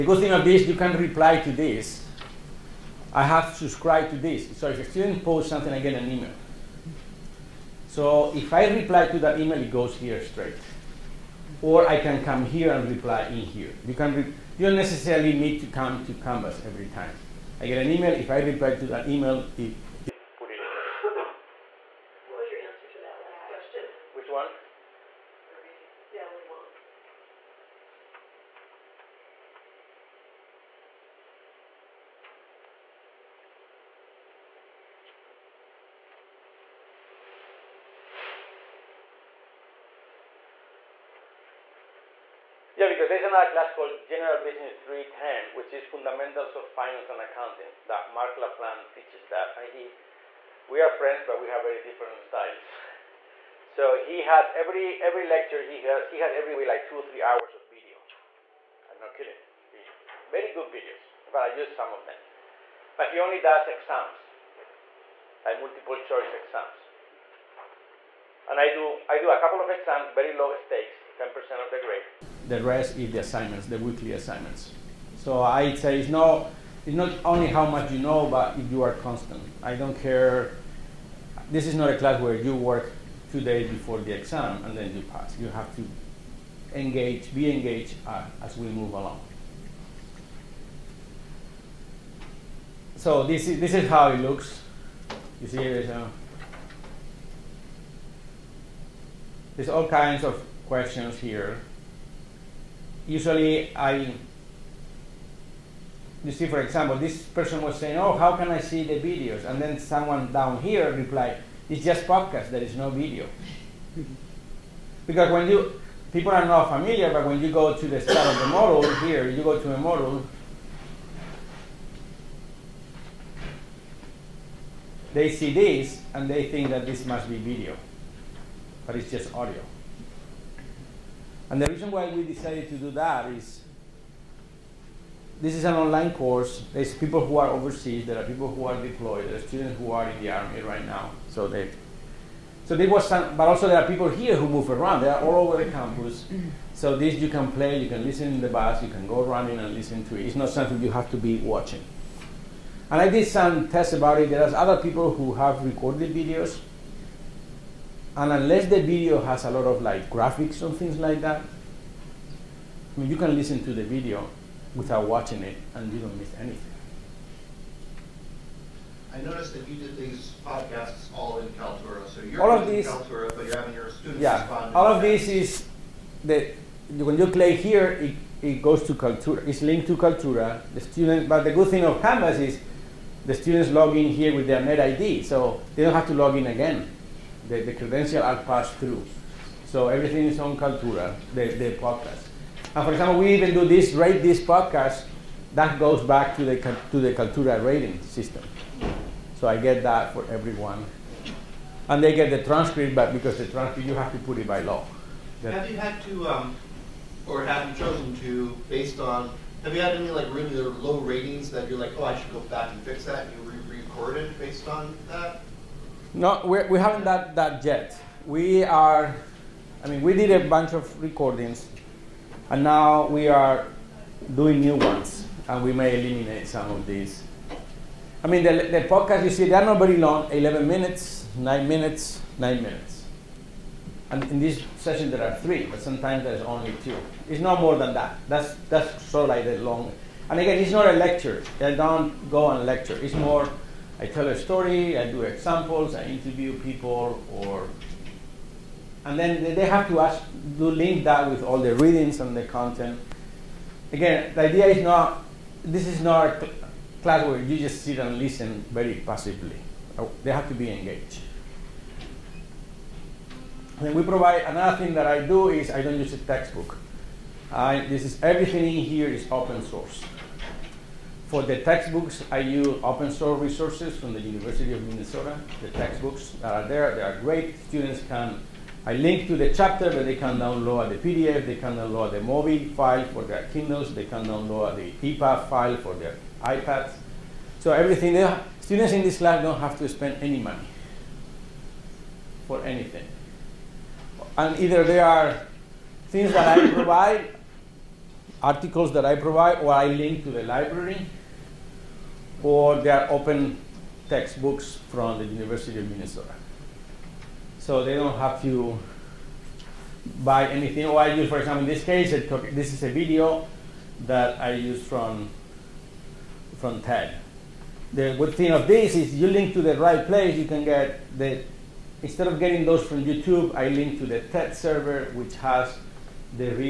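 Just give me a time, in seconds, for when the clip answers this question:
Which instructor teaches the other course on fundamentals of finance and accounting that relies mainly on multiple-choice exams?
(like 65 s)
48 s.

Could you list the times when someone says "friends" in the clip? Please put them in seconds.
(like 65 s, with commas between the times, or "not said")
50 s.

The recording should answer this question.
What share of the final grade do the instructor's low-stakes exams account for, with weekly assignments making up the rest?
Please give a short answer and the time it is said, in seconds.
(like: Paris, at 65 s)
10%, at 71 s.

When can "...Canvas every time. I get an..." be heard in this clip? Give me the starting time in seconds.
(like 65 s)
16 s.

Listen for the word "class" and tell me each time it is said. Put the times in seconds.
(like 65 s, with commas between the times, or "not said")
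43 s, 81 s, 257 s, 289 s.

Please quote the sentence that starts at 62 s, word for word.
But he only does exams, like multiple choice exams.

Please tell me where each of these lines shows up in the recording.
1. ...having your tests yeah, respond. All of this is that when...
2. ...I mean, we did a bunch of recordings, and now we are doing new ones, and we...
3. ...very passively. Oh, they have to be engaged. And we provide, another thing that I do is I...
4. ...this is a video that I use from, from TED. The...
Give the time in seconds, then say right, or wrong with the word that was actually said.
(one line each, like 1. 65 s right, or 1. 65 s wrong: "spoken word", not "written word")
1. 173 s wrong: "students", not "tests"
2. 219 s right
3. 258 s right
4. 312 s right.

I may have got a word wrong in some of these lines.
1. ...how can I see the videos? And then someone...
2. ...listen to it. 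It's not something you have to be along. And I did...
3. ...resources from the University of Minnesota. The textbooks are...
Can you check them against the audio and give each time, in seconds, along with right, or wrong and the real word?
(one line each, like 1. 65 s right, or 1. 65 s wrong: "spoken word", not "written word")
1. 108 s right
2. 149 s wrong: "watching", not "along"
3. 273 s right.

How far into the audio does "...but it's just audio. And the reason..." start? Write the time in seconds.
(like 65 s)
128 s.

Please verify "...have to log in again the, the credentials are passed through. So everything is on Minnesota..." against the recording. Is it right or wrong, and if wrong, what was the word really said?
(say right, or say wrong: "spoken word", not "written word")
wrong: "Kaltura", not "Minnesota".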